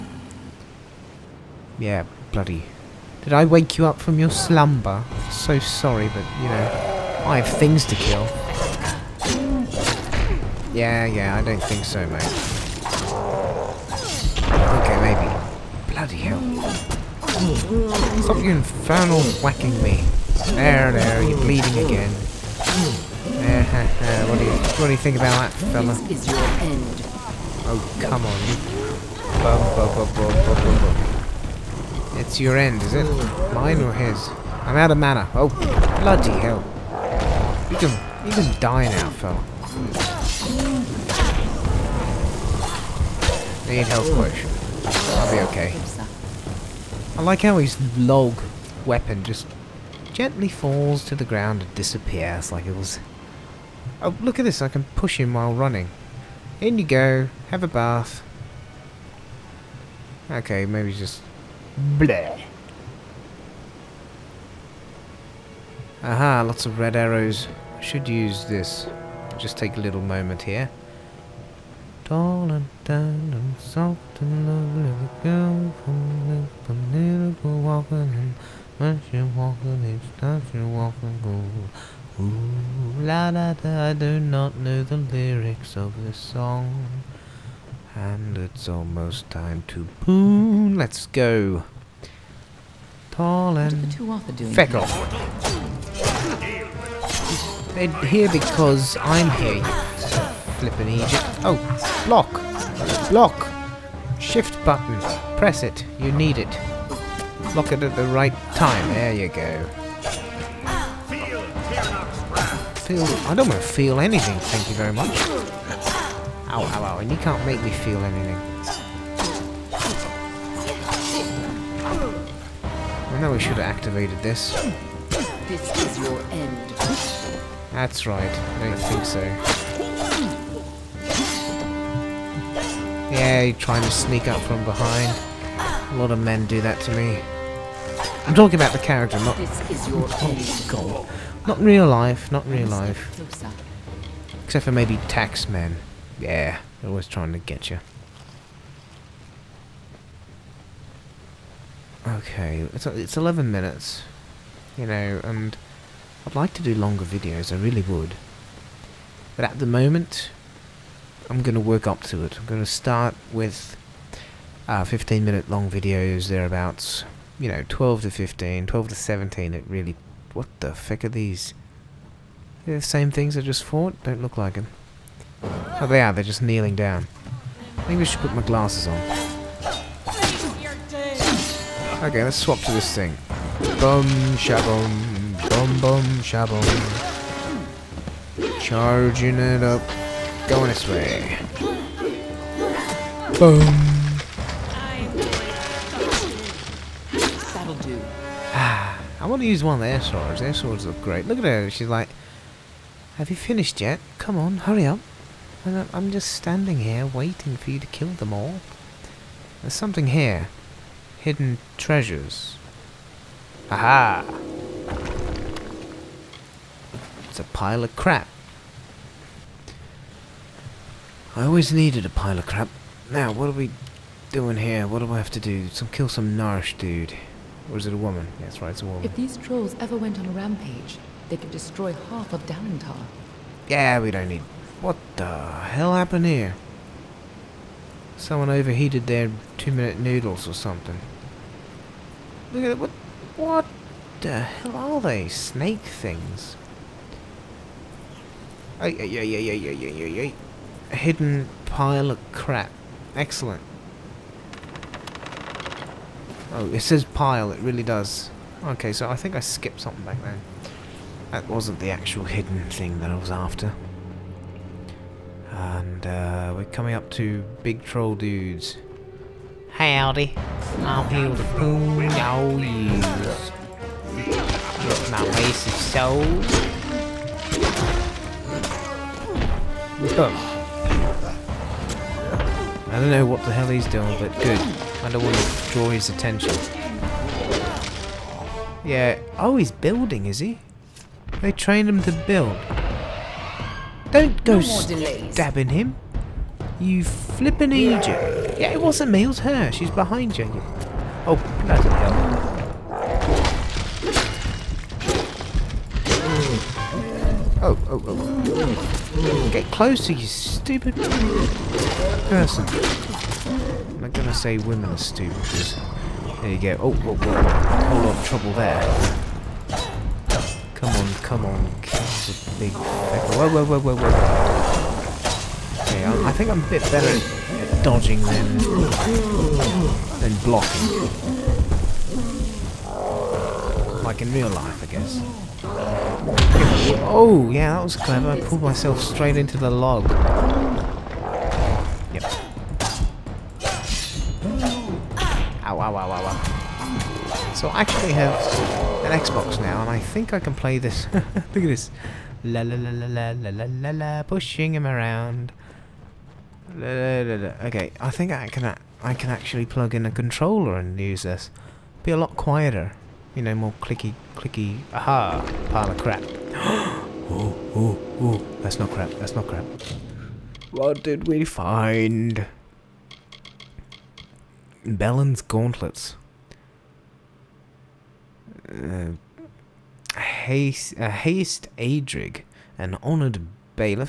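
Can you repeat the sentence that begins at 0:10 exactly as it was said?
Yeah, yeah, I don't think so, mate.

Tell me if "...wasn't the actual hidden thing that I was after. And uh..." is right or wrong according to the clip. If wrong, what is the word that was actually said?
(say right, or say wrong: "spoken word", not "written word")
right.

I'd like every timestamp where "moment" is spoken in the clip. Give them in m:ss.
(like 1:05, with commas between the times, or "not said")
1:09, 2:39.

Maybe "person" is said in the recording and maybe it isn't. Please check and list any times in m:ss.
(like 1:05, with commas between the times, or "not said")
5:12.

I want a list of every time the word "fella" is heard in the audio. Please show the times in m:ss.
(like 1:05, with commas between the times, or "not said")
0:25, 0:39.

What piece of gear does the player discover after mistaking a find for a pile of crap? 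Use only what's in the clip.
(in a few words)
Belen's gauntlets.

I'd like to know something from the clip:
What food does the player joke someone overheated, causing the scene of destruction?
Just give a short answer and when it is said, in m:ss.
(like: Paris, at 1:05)
two-minute noodles, at 3:59.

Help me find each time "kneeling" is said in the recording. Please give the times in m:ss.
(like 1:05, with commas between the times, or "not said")
2:56.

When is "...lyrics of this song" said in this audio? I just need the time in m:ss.
1:24.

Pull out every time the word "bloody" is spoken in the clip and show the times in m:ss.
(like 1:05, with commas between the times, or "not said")
0:02, 0:15, 0:36.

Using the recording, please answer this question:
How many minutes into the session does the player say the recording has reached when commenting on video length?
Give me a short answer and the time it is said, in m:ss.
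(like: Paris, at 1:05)
11, at 2:33.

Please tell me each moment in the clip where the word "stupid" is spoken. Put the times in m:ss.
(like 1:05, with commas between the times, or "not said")
5:10, 5:14.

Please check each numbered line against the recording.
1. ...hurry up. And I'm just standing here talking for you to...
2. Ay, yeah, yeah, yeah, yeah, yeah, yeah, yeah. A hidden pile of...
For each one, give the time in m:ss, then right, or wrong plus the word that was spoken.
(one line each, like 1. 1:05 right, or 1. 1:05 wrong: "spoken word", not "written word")
1. 3:24 wrong: "waiting", not "talking"
2. 4:08 right.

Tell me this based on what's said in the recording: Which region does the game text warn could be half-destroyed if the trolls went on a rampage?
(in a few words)
Dalentarth.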